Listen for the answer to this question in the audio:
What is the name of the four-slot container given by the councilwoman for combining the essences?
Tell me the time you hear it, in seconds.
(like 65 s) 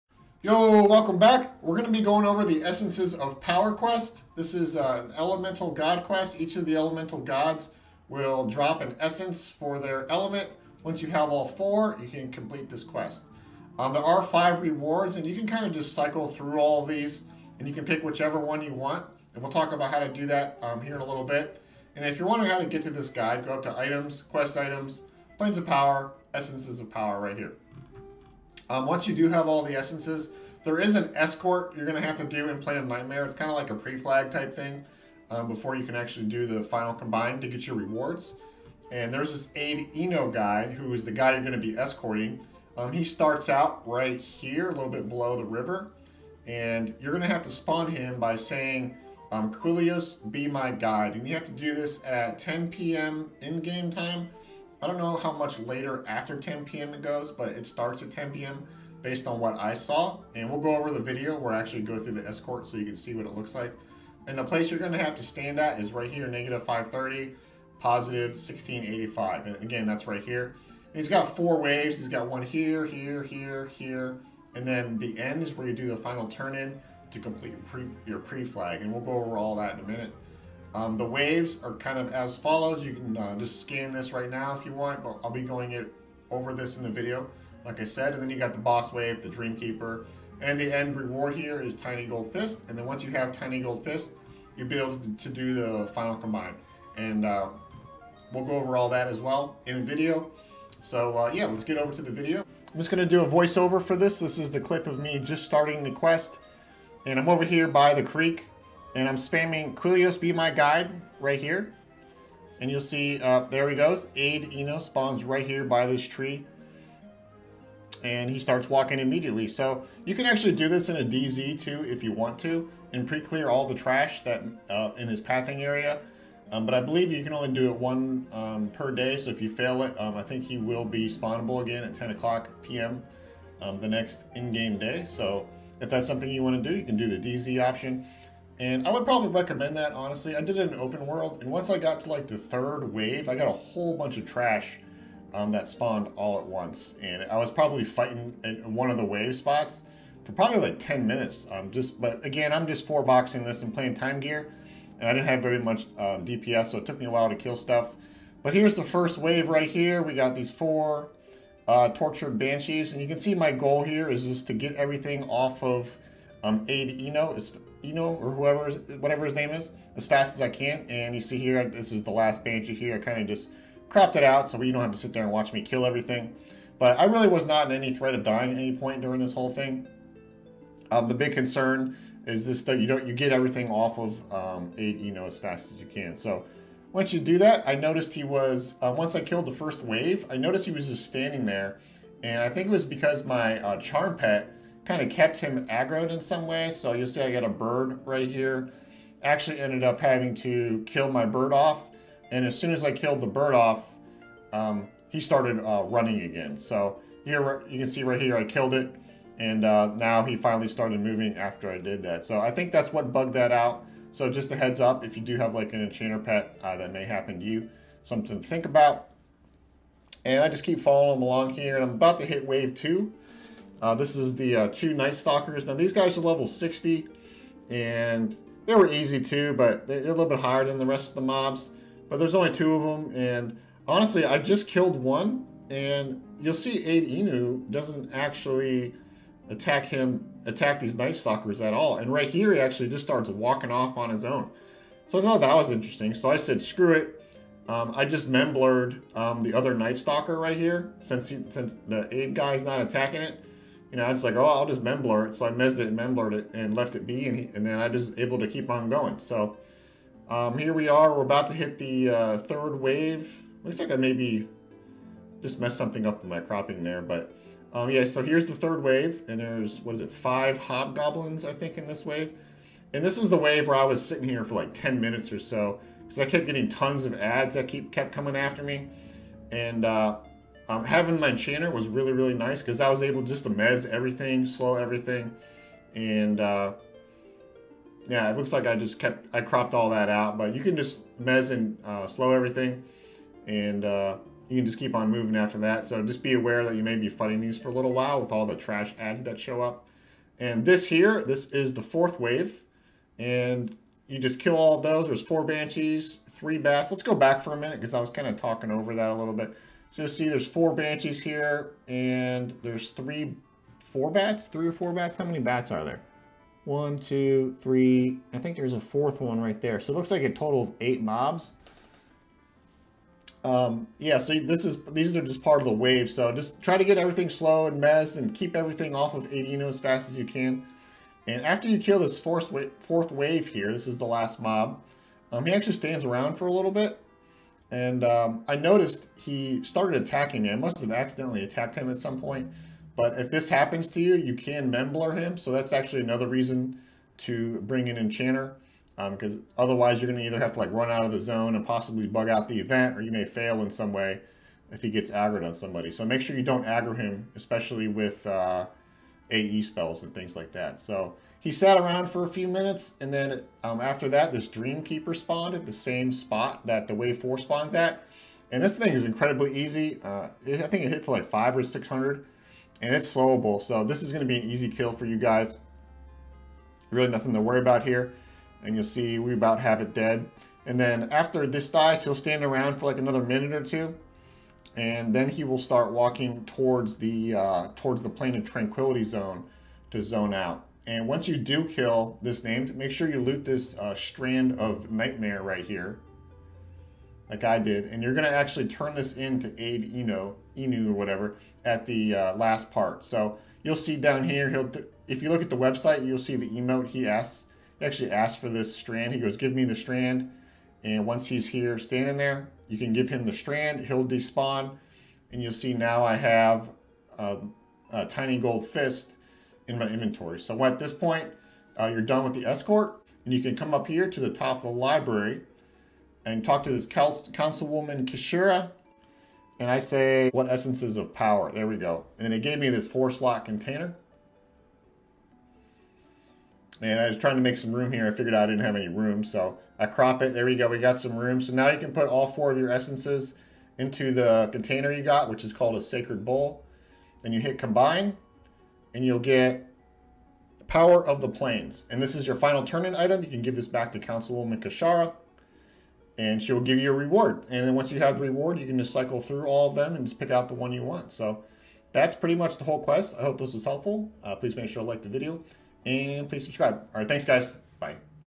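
445 s.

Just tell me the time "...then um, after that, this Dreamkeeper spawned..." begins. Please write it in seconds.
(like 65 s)
363 s.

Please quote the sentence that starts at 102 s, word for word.
I'm just gonna do a voiceover for this.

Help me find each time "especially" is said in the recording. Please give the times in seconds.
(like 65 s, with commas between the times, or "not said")
357 s.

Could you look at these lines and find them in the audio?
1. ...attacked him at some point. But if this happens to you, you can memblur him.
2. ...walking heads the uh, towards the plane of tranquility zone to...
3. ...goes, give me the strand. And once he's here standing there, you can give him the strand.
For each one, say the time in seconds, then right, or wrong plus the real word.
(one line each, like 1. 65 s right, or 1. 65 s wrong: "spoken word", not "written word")
1. 341 s right
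2. 385 s wrong: "towards", not "heads"
3. 409 s right.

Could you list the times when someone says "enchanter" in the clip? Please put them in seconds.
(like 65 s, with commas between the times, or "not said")
215 s, 281 s, 347 s.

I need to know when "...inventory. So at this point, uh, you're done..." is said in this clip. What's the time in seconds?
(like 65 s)
419 s.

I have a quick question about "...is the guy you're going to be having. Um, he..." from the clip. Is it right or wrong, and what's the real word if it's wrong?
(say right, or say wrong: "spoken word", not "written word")
wrong: "escorting", not "having".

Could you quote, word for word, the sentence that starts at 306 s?
Let's go back for a minute because I was kind of talking over that a little bit.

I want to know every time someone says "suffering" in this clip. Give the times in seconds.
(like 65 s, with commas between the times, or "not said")
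not said.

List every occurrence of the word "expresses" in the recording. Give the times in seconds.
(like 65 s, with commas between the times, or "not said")
not said.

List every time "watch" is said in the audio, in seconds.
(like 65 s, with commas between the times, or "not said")
175 s.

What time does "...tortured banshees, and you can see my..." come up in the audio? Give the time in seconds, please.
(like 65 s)
161 s.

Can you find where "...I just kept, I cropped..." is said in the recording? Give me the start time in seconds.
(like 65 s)
288 s.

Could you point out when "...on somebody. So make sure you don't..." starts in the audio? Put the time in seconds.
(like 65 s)
355 s.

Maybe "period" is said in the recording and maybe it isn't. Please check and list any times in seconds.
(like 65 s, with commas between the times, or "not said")
not said.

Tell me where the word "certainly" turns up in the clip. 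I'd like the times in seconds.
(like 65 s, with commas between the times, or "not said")
not said.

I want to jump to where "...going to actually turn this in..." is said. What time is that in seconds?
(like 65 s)
398 s.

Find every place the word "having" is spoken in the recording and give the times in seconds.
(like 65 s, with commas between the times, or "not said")
199 s, 280 s.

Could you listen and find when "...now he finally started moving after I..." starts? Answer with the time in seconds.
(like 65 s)
209 s.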